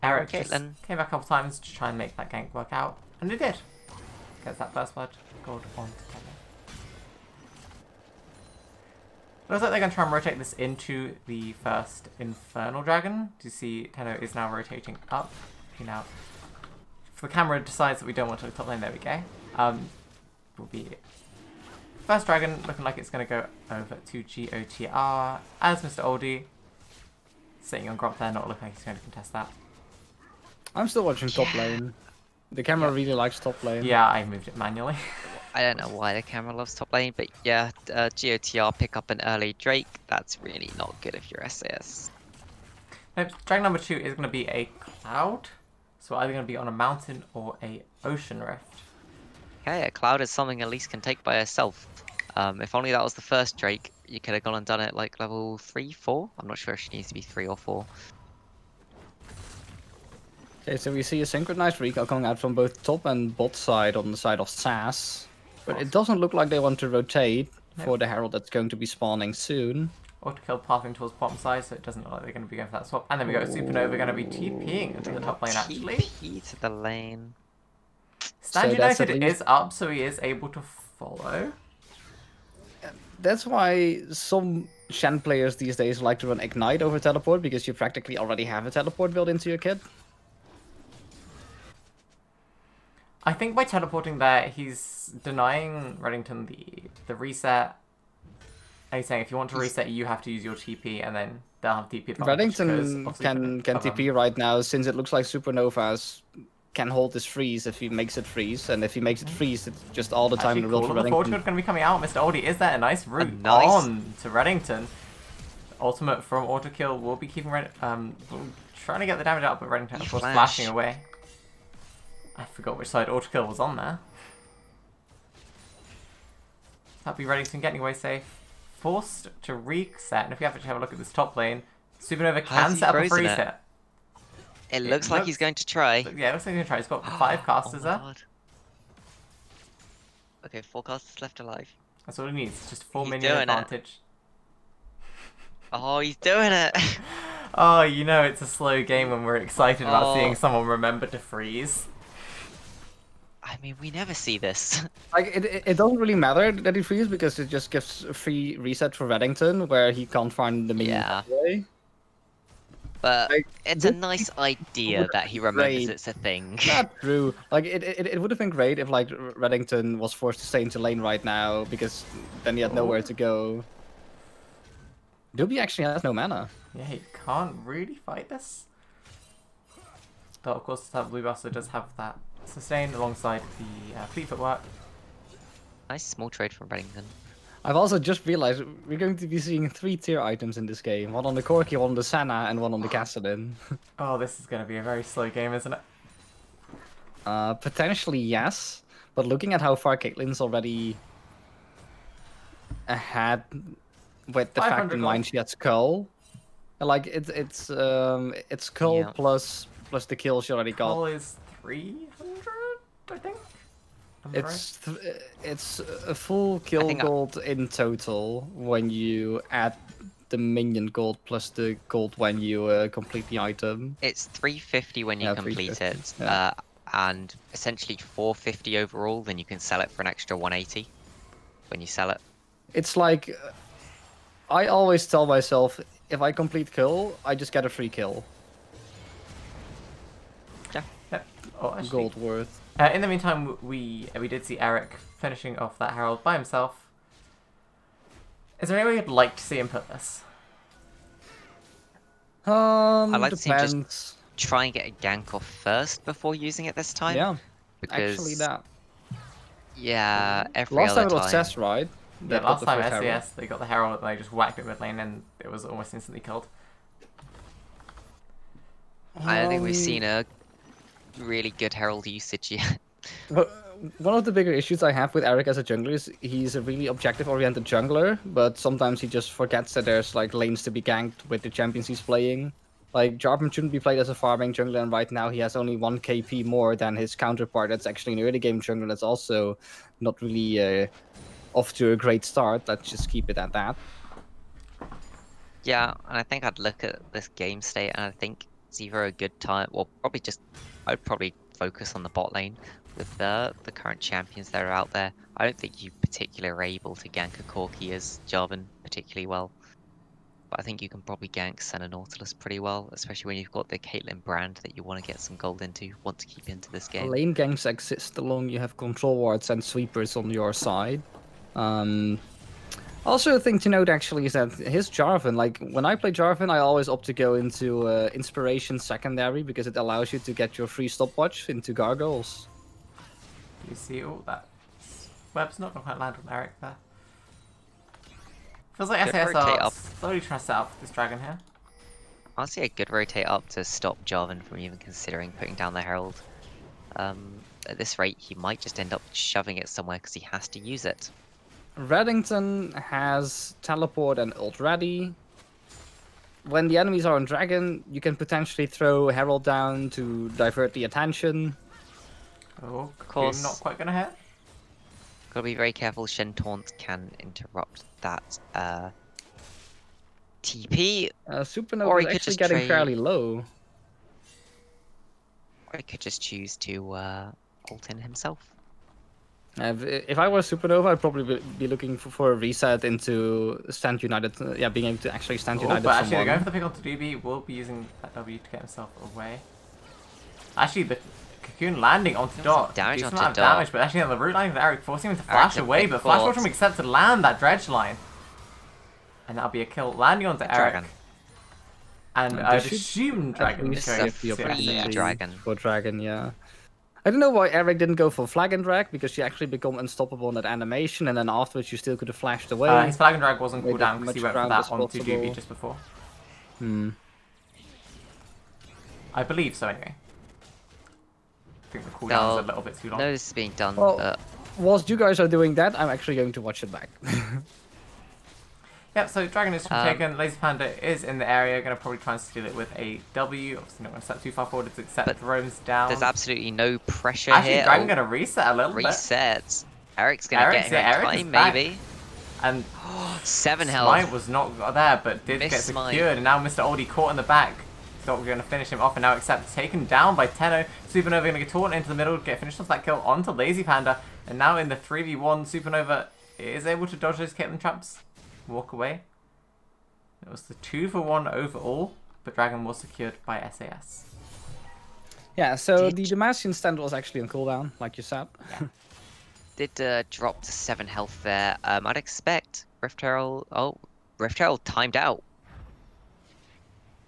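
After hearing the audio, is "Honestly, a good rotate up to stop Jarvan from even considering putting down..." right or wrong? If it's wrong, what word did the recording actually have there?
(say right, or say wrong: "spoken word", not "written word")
right.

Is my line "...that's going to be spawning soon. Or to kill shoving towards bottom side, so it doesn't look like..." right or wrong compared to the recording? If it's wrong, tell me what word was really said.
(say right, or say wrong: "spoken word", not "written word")
wrong: "pathing", not "shoving".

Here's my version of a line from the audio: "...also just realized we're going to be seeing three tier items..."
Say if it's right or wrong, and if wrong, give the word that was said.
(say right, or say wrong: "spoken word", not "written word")
right.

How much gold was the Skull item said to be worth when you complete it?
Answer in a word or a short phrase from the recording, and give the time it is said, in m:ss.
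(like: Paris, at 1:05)
350, at 3:44.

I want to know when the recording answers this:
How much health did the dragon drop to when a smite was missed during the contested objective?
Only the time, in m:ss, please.
7:23.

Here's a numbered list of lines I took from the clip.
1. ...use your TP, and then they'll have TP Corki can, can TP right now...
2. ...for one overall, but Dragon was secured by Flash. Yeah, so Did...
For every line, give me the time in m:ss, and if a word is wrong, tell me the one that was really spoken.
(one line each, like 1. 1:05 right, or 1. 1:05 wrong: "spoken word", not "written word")
1. 1:40 wrong: "Reddington", not "Corki"
2. 7:40 wrong: "SAS", not "Flash".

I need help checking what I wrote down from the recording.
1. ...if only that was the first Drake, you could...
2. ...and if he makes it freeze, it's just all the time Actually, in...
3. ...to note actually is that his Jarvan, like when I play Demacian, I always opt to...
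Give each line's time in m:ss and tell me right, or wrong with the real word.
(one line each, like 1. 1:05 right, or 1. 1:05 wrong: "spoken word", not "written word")
1. 0:52 right
2. 1:48 right
3. 5:23 wrong: "Jarvan", not "Demacian".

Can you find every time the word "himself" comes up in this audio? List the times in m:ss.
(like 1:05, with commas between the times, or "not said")
4:06, 6:17, 6:28.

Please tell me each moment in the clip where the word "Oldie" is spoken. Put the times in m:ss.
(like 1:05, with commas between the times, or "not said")
0:26, 1:52, 7:26.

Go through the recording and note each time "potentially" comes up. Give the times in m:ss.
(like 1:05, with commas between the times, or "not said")
3:17, 5:58.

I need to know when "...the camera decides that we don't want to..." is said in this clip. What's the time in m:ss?
0:17.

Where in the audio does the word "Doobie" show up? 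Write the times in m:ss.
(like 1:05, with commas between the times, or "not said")
2:55, 6:55.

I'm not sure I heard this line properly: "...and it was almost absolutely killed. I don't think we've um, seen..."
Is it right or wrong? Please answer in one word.
wrong.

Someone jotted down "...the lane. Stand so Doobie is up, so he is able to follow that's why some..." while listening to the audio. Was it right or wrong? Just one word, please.
wrong.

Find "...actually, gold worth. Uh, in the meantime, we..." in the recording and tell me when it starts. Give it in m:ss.
4:01.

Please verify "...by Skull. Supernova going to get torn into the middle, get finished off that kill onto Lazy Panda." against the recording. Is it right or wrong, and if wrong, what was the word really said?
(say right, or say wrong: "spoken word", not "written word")
wrong: "Tenno", not "Skull".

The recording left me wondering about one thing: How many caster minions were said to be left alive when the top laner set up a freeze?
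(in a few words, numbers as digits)
4.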